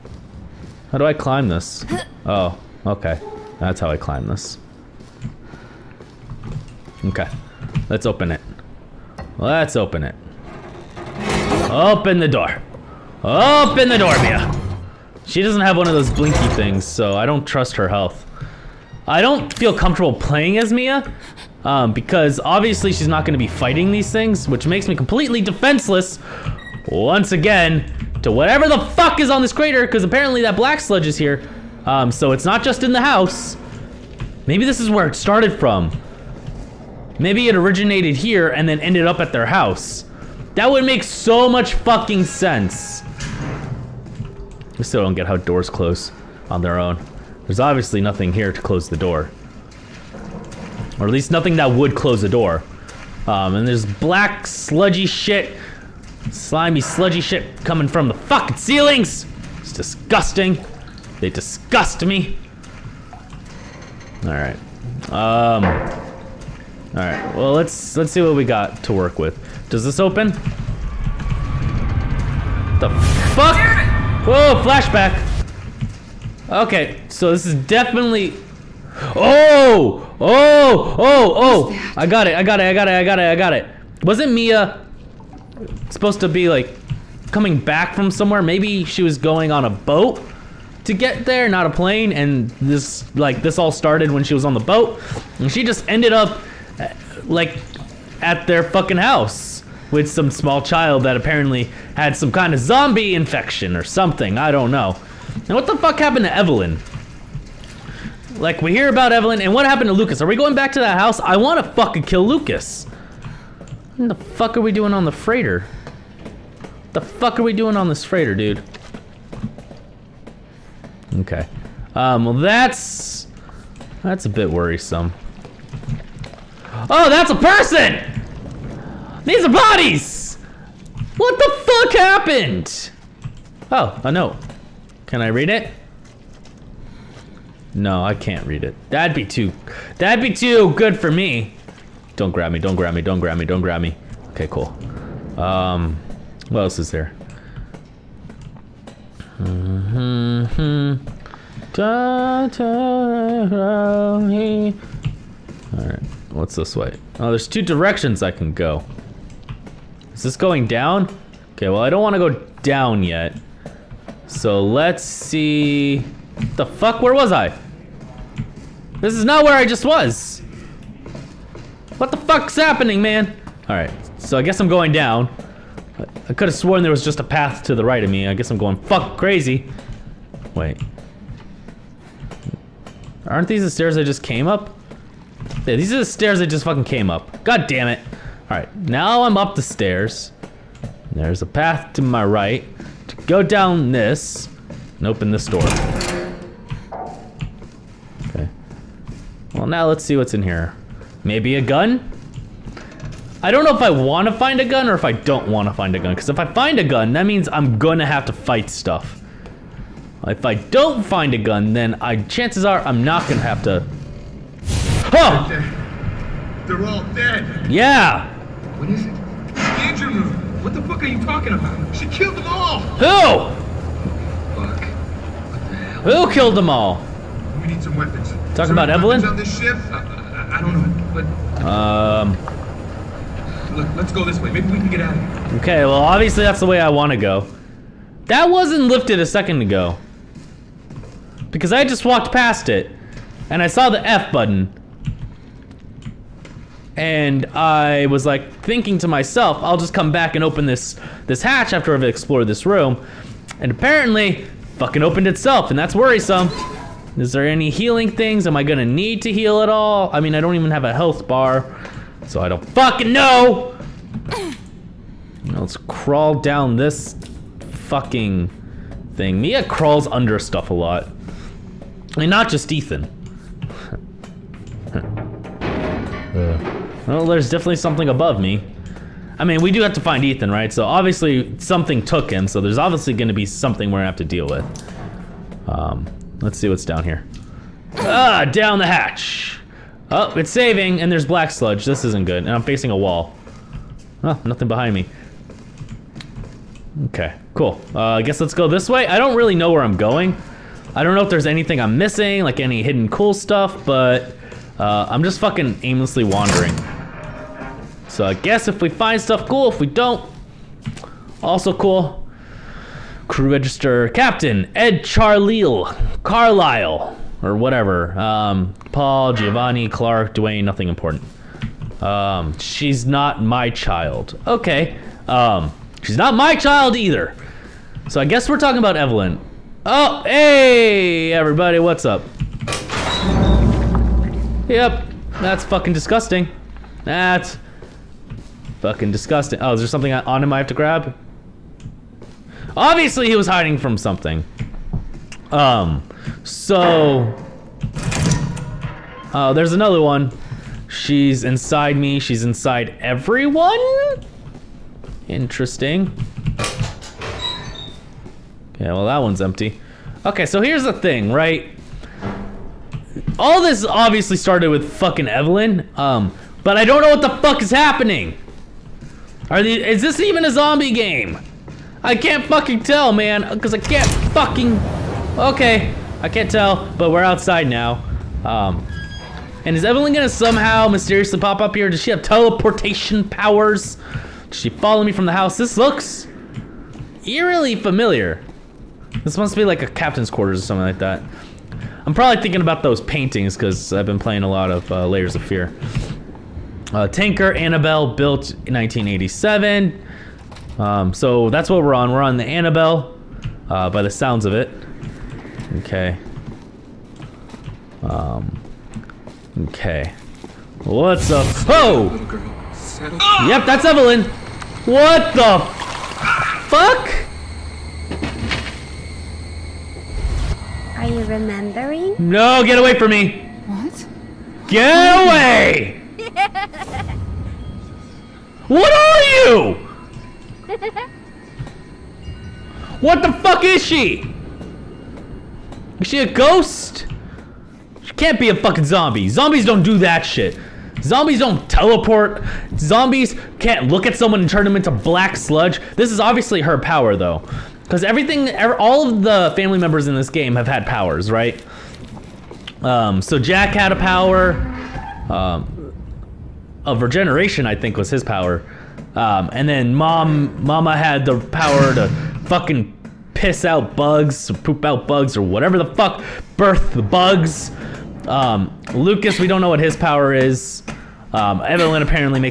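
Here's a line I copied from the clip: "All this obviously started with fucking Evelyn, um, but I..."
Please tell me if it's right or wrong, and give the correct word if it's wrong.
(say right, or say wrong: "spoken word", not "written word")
right.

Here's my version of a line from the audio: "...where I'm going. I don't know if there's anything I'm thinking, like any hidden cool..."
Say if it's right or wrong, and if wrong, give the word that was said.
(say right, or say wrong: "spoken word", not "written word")
wrong: "missing", not "thinking".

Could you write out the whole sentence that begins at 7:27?
Because everything, er, all of the family members in this game have had powers, right?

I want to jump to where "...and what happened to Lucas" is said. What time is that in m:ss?
1:49.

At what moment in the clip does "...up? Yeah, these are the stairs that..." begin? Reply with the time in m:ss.
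3:04.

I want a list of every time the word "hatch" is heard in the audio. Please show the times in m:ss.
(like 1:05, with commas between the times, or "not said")
4:11, 4:48.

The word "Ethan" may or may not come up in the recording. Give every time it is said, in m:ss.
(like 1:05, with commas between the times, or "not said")
4:32, 4:40.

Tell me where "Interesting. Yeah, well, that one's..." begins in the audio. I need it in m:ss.
5:55.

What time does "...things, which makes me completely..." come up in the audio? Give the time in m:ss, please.
0:24.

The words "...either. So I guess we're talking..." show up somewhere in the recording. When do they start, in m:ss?
5:26.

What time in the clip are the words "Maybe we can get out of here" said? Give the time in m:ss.
3:54.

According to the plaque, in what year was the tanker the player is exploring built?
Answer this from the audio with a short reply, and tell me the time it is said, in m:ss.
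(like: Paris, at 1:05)
1987, at 6:38.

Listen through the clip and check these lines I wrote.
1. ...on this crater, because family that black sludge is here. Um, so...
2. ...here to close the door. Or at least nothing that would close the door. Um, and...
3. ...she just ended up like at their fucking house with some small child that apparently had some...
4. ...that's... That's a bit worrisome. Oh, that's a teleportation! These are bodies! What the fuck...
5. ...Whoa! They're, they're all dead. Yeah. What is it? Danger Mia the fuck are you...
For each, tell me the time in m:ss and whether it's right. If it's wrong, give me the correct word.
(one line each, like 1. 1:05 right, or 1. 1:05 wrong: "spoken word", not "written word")
1. 0:29 wrong: "apparently", not "family"
2. 0:48 right
3. 1:35 right
4. 2:02 wrong: "person", not "teleportation"
5. 3:35 wrong: "What", not "Mia".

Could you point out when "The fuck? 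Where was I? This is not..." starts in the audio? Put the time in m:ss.
2:46.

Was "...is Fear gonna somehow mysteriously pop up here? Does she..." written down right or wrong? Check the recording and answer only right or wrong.
wrong.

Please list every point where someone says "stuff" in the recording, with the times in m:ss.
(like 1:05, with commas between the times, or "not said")
3:28, 4:30, 5:03, 5:09.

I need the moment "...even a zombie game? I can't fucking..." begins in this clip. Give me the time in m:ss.
6:10.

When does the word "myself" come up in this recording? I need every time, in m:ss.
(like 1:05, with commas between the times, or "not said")
4:09.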